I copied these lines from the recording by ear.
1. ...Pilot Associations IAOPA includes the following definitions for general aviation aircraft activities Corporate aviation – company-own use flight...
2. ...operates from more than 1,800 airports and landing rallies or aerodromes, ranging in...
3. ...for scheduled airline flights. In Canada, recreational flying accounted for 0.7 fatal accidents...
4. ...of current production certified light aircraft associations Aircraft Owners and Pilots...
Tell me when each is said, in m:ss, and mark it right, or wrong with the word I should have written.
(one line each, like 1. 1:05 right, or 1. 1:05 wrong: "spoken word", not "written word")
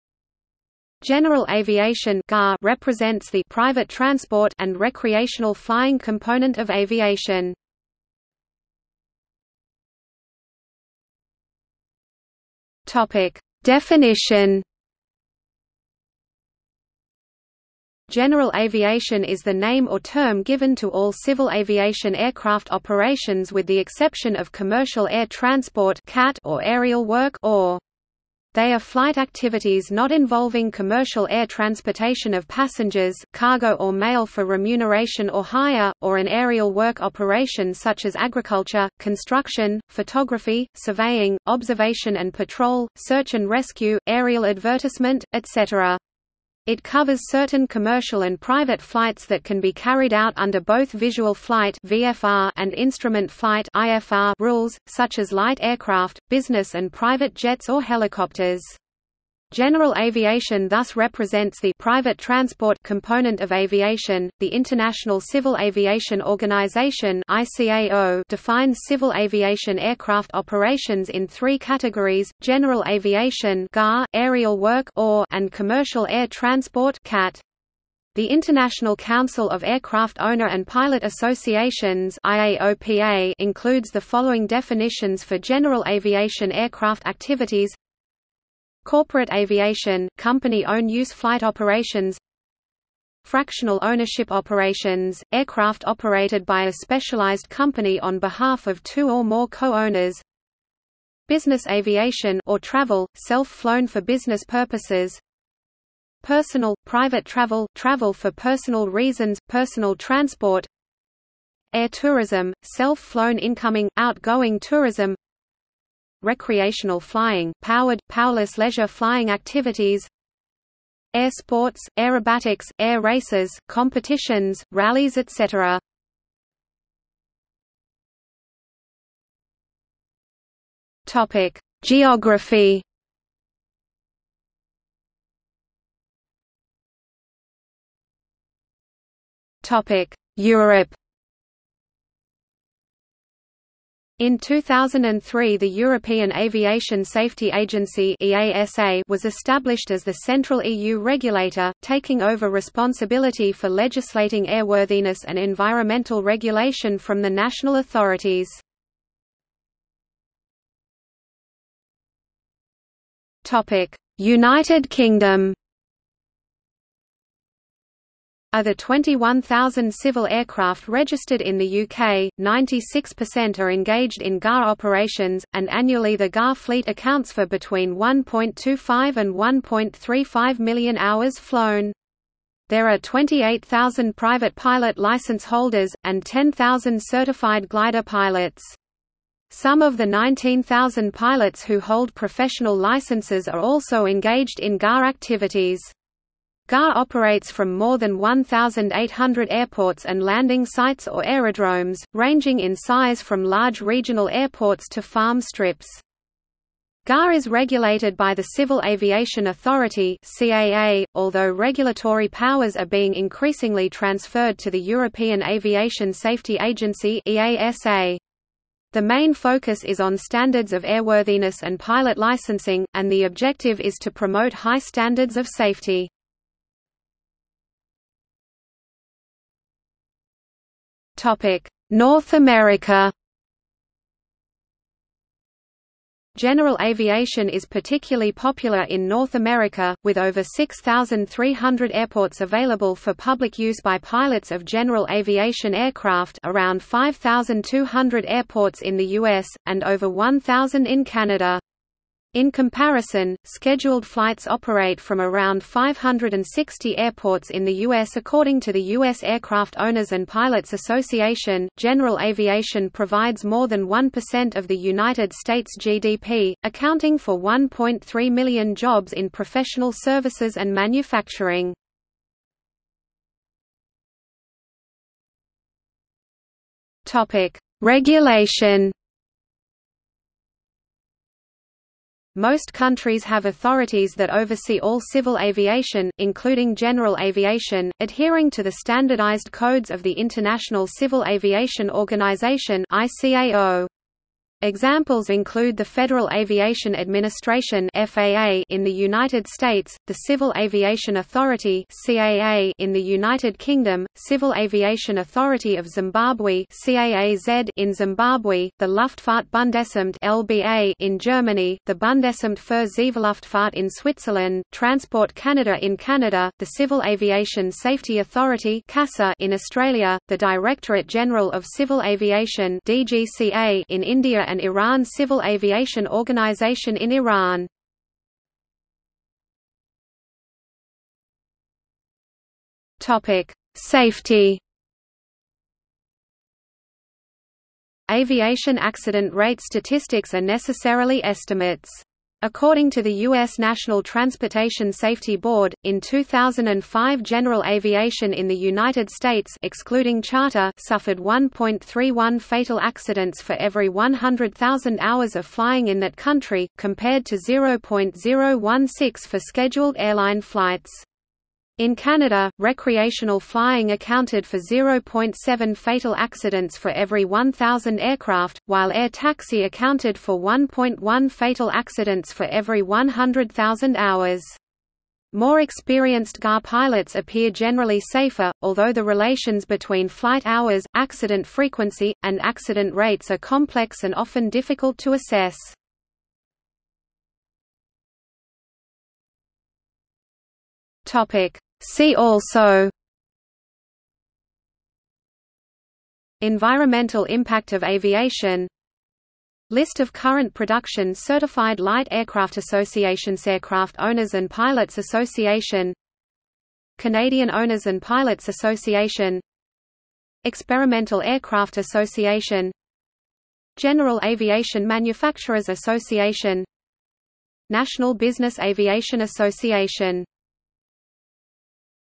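1. 1:20 right
2. 3:16 wrong: "sites", not "rallies"
3. 5:59 right
4. 6:39 right.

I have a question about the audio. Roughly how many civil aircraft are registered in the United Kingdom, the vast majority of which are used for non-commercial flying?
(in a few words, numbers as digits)
21,000.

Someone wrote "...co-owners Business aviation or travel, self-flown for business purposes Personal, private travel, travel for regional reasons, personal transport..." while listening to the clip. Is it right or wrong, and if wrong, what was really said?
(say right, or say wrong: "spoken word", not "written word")
wrong: "personal", not "regional".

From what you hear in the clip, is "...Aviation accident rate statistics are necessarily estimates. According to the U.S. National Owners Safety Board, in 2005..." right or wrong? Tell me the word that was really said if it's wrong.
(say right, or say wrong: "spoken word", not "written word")
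wrong: "Transportation", not "Owners".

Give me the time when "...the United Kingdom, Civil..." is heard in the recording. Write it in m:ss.
5:02.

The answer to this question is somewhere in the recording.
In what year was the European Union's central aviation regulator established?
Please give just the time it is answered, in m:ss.
2:24.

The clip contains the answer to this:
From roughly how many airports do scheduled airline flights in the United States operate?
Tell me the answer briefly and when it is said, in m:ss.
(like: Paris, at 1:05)
560, at 4:15.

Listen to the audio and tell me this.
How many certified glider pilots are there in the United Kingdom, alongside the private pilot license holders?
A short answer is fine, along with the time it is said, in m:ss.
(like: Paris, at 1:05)
10,000, at 3:06.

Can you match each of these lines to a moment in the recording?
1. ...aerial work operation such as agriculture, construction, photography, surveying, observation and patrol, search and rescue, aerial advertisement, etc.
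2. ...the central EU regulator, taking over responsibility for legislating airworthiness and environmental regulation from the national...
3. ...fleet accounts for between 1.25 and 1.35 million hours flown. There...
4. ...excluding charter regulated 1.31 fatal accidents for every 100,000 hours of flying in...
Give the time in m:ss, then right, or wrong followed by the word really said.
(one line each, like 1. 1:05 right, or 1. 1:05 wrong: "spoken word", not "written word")
1. 0:36 right
2. 2:30 right
3. 2:56 right
4. 5:49 wrong: "suffered", not "regulated".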